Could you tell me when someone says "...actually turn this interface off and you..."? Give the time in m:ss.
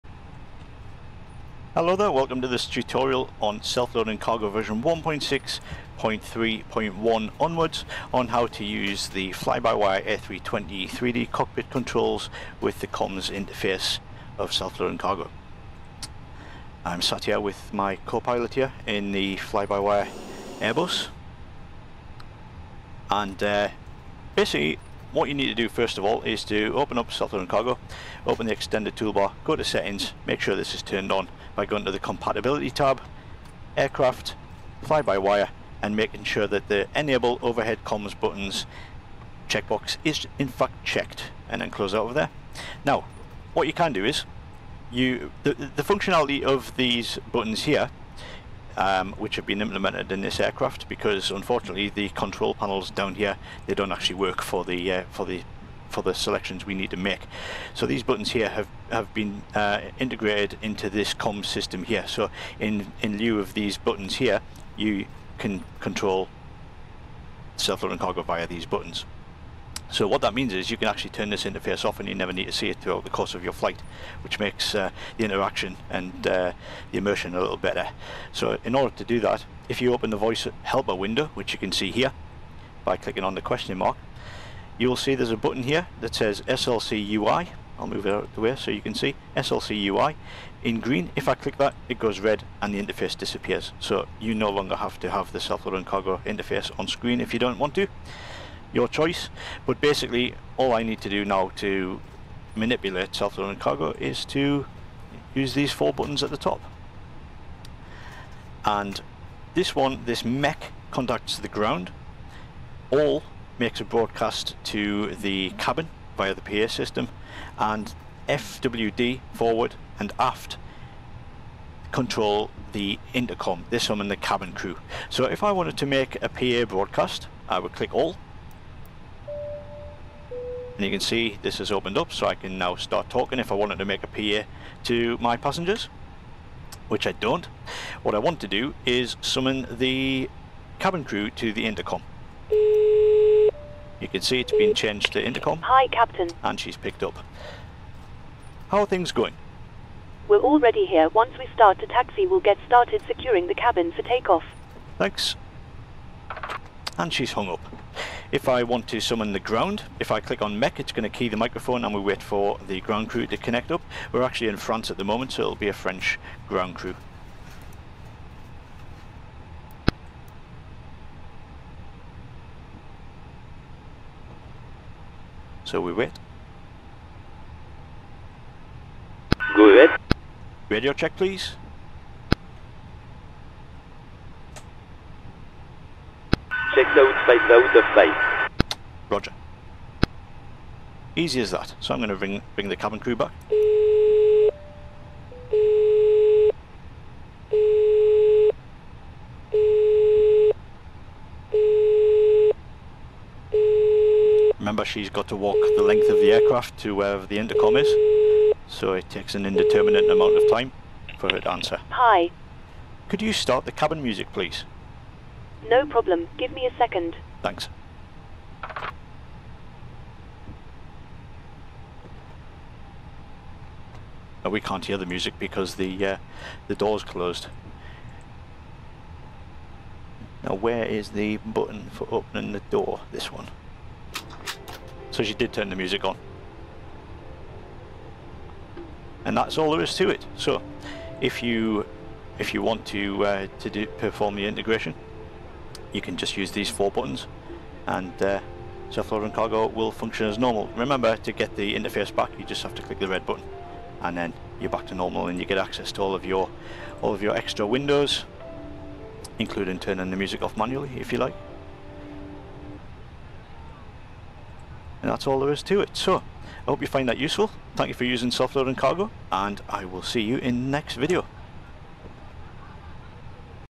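1:10.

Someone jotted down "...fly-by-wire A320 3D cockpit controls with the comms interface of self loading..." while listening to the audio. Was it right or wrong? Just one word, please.
right.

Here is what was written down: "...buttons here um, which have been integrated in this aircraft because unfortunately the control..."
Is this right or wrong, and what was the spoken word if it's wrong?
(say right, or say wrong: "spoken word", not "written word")
wrong: "implemented", not "integrated".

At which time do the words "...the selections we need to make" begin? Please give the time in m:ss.
0:56.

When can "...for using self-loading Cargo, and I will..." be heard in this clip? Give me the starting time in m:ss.
4:27.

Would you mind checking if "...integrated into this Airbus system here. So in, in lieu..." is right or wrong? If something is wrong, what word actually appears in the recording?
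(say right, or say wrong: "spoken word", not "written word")
wrong: "COM", not "Airbus".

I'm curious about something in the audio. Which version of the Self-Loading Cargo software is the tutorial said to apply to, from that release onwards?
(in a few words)
1.6.3.1.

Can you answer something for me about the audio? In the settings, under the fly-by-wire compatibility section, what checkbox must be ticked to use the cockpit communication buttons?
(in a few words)
Enable overhead comms buttons.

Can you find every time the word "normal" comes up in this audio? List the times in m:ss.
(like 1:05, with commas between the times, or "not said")
4:10, 4:14.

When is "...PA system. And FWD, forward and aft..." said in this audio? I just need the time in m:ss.
1:56.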